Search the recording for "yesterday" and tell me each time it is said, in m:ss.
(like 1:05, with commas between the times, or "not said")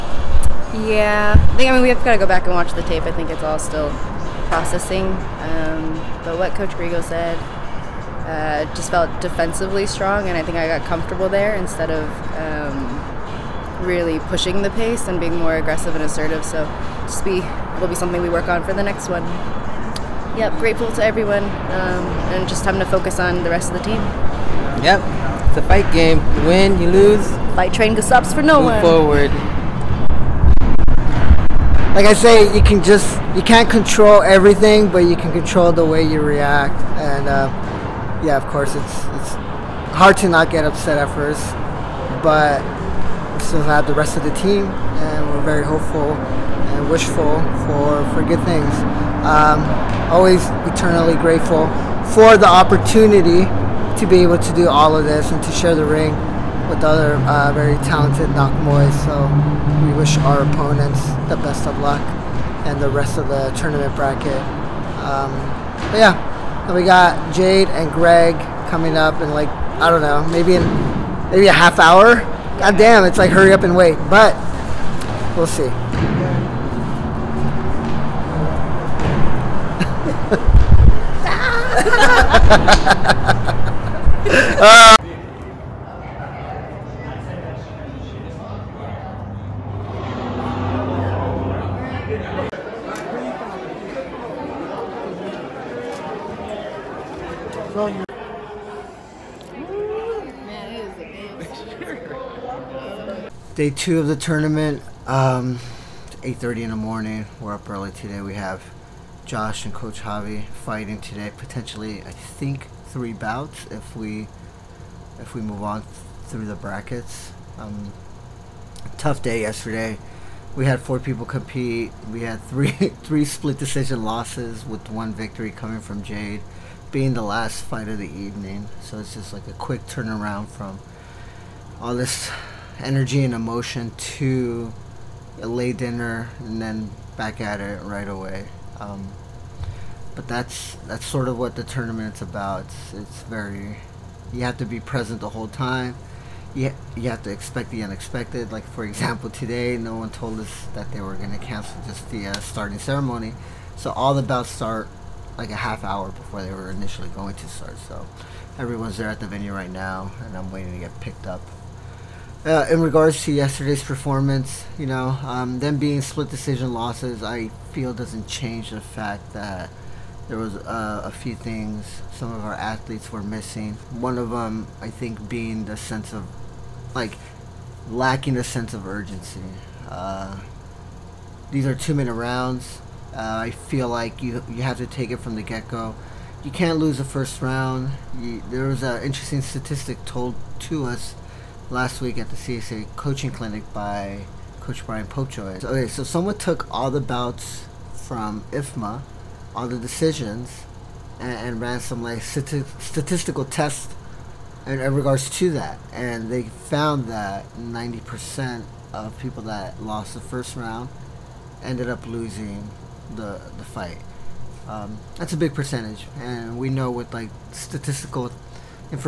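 1:59, 2:43.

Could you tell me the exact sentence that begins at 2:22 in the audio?
It's, it's very you have to be present the whole time.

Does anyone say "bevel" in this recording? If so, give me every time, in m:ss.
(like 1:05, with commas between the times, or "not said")
not said.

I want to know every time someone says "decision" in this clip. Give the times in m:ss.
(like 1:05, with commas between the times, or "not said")
2:03, 2:46, 3:19.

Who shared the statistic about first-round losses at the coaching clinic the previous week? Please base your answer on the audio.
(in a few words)
Brian Popejoy.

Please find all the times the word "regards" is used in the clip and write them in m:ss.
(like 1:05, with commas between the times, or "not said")
2:42, 3:24.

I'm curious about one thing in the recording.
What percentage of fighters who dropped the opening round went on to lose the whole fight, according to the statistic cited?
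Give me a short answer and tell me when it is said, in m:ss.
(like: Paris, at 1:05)
90%, at 3:27.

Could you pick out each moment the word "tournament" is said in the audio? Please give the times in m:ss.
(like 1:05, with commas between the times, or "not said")
1:03, 1:44, 2:21.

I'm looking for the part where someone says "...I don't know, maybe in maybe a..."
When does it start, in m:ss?
1:09.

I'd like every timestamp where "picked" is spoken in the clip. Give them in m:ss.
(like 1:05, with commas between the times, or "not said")
2:40.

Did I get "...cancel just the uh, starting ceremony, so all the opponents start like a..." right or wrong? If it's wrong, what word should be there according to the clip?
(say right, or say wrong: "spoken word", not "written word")
wrong: "bouts", not "opponents".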